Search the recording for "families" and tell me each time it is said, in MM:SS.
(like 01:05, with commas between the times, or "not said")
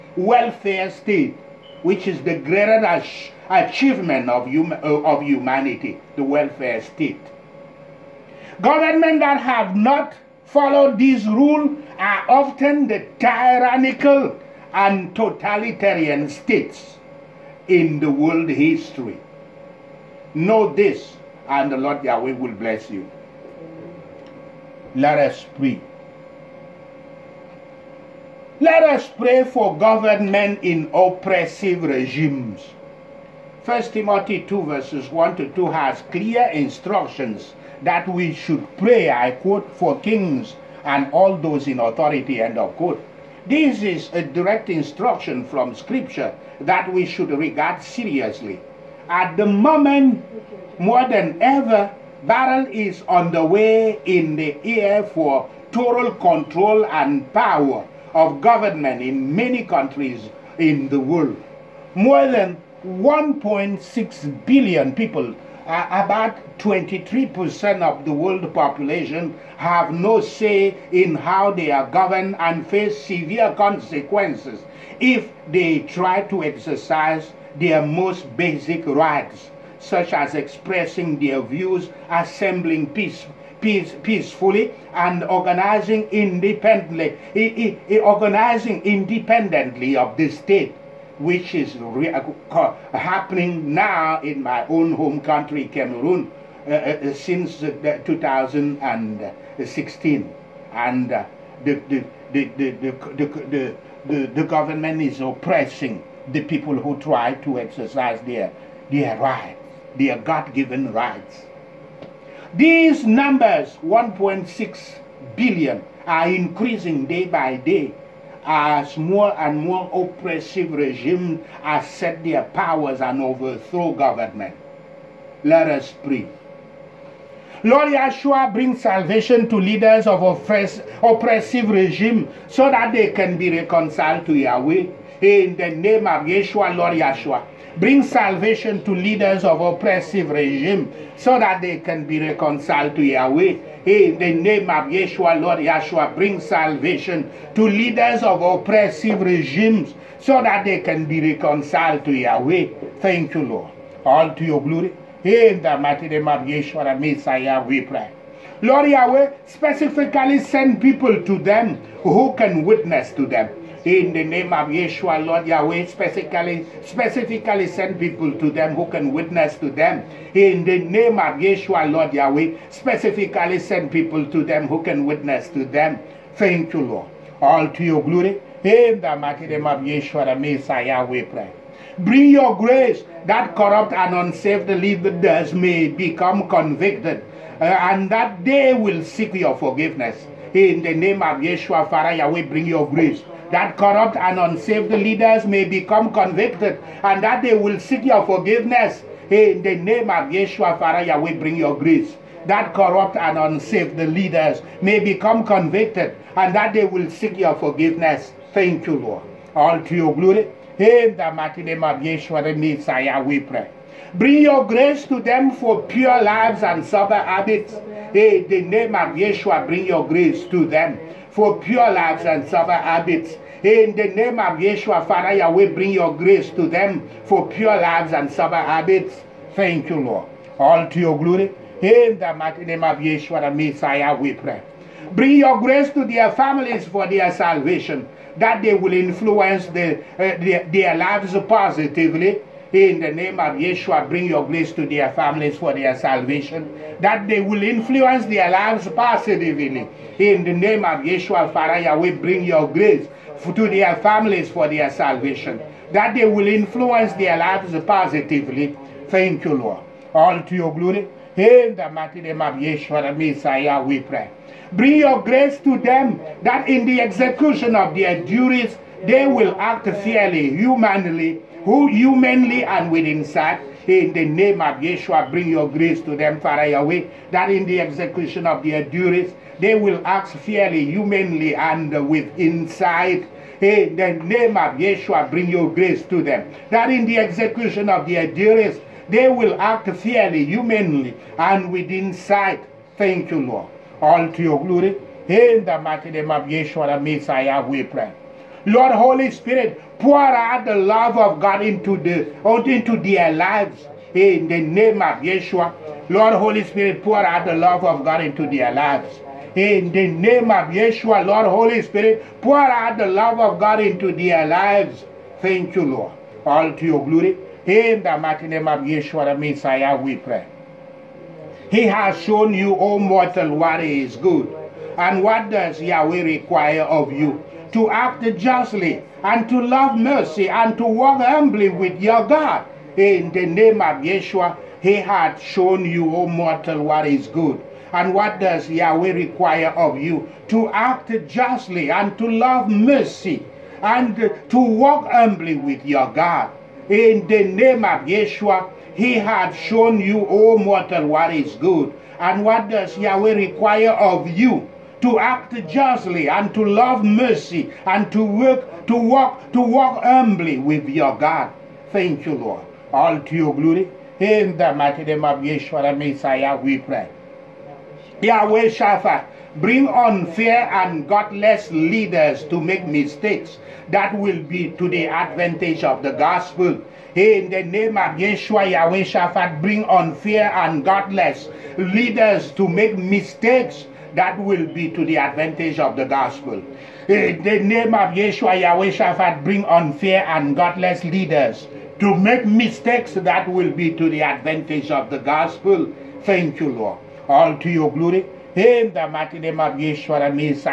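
03:56, 04:05, 04:13.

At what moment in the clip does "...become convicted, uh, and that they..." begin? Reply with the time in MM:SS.
03:05.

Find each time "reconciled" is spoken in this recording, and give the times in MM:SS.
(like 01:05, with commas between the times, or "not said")
02:13, 02:22, 02:31.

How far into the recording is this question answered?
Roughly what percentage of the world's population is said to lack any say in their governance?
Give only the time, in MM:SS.
01:06.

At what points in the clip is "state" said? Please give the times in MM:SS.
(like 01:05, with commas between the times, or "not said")
00:00, 00:06, 00:16, 01:30.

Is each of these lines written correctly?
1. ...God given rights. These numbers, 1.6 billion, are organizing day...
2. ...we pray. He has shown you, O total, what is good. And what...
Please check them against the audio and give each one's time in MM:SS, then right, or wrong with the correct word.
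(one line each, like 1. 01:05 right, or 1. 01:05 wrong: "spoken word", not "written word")
1. 01:50 wrong: "increasing", not "organizing"
2. 05:19 wrong: "mortal", not "total".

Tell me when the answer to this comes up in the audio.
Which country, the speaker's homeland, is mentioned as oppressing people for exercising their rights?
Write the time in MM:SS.
01:35.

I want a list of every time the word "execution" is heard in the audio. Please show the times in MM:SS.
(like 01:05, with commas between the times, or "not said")
04:27, 04:37, 04:47.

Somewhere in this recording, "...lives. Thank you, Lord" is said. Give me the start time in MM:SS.
05:14.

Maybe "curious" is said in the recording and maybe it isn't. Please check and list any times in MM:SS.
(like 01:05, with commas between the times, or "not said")
not said.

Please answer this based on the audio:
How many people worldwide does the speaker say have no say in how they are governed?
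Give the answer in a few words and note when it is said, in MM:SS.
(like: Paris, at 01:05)
1.6 billion, at 01:01.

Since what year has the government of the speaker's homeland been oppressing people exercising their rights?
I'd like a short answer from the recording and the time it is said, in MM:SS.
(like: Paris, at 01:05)
2016, at 01:37.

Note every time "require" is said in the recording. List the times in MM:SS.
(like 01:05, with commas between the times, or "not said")
05:26, 05:39, 05:53.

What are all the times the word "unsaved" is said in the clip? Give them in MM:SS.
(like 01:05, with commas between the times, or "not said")
03:04, 03:14, 03:23.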